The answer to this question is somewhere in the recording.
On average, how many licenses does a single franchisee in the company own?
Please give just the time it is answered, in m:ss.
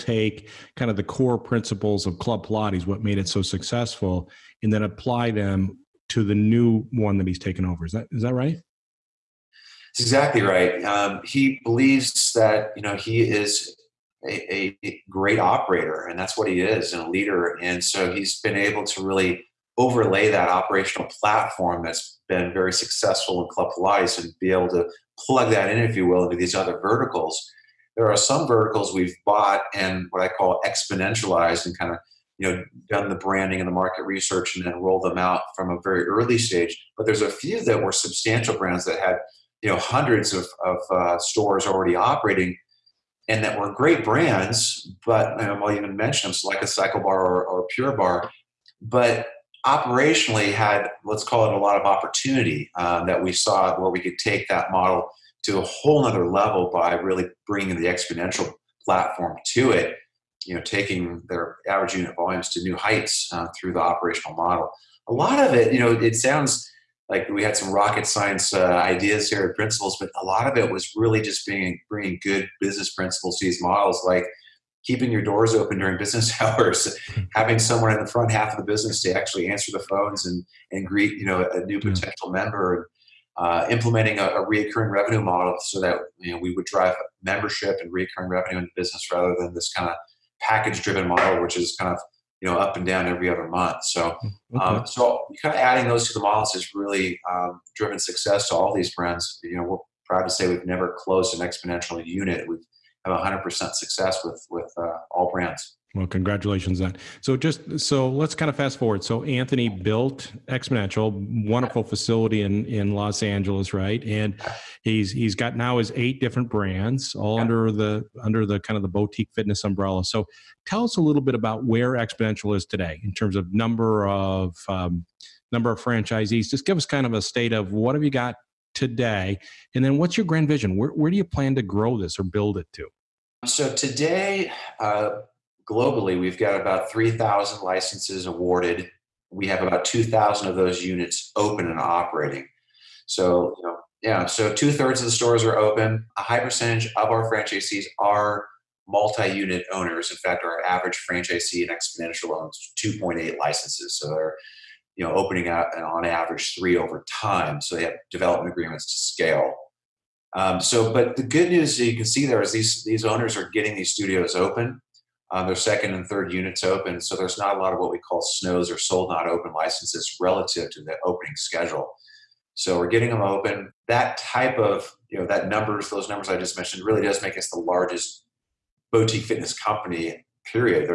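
2:32.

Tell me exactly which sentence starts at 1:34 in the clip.
um, so kind of adding those to the models has really um, driven success to all these brands.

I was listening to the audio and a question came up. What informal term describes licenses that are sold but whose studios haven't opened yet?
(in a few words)
snows.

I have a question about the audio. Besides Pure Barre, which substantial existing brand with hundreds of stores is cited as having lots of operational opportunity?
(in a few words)
CycleBar.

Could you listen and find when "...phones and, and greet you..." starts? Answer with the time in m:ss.
1:19.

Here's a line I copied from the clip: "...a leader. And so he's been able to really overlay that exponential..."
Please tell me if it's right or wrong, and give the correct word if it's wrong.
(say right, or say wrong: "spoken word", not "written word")
wrong: "operational", not "exponential".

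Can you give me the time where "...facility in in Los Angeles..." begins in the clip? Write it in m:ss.
1:51.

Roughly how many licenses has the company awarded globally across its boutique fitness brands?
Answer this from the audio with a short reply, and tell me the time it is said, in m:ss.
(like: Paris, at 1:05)
3,000, at 2:16.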